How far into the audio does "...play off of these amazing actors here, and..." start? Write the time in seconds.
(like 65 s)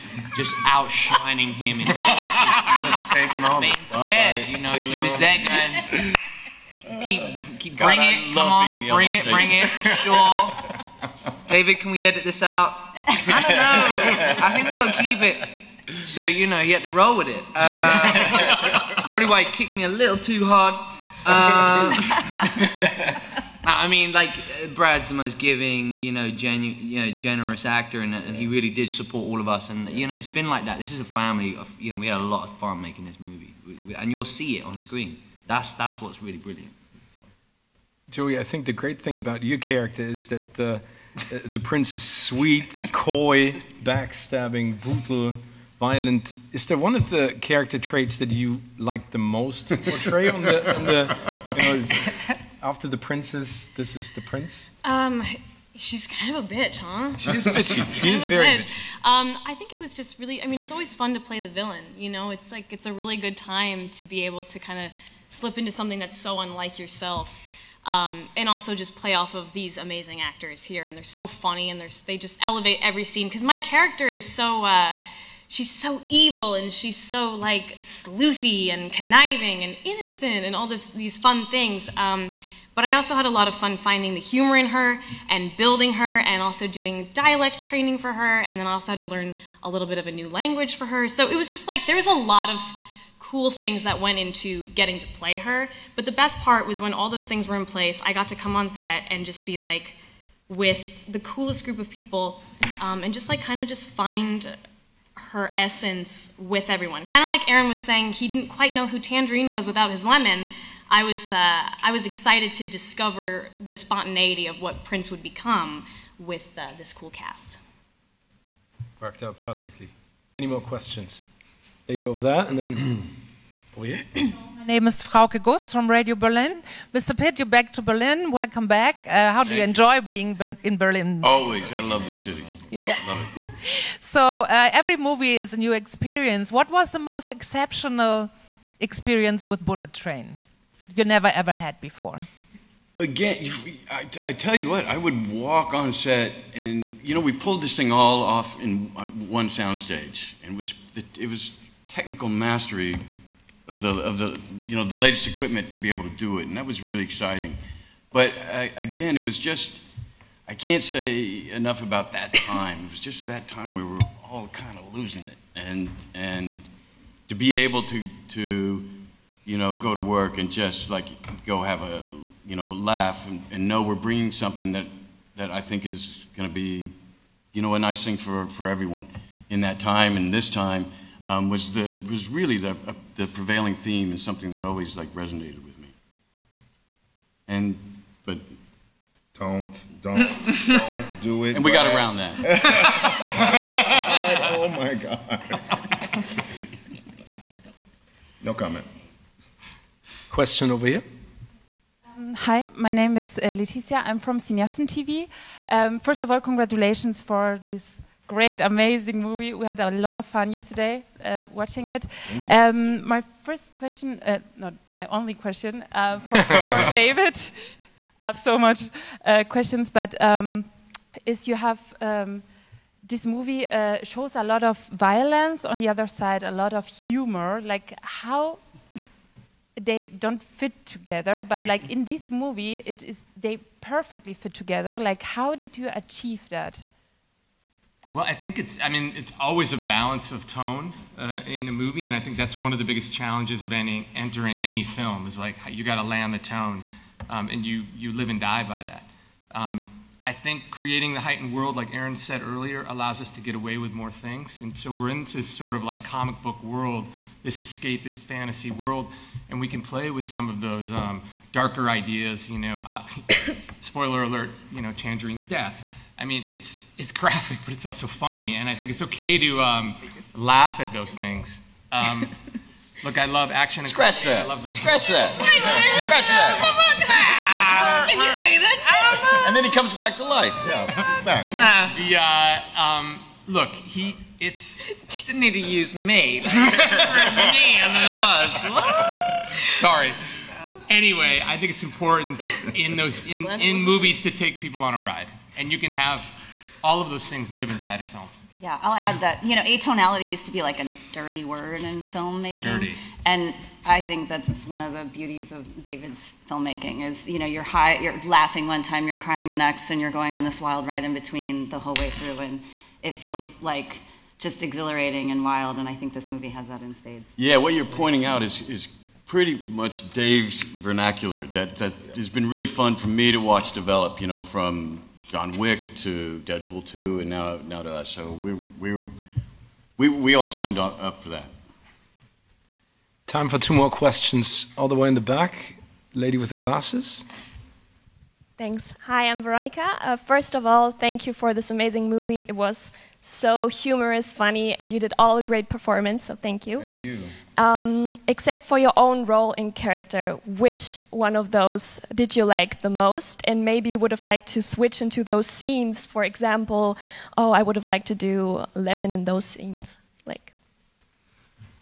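68 s.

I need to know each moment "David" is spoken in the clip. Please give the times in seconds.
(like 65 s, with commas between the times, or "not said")
11 s, 216 s, 305 s.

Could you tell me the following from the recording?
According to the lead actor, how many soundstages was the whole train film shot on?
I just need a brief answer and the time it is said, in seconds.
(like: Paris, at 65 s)
1, at 149 s.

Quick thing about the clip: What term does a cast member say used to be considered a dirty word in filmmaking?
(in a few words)
atonality.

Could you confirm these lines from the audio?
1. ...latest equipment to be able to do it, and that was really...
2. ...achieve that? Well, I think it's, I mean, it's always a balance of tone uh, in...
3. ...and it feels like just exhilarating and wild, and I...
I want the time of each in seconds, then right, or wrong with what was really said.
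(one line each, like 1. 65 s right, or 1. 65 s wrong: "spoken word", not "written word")
1. 154 s right
2. 235 s right
3. 312 s right.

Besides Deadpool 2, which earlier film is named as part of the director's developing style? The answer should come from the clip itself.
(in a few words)
John Wick.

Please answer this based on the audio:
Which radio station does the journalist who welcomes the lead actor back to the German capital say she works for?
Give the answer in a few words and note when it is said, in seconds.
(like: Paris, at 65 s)
Radio Berlin, at 125 s.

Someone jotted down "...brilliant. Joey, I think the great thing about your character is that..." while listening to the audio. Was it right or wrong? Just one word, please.
right.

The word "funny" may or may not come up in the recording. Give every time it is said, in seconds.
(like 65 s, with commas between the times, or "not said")
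71 s, 268 s, 344 s.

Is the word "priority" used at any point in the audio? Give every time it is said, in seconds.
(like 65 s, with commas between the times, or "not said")
not said.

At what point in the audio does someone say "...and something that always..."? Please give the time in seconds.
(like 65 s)
184 s.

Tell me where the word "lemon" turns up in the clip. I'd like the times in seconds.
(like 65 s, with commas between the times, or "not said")
110 s, 358 s.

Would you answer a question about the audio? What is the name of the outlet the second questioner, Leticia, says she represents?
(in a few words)
Cineasten TV.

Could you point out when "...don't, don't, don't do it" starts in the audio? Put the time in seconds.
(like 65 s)
189 s.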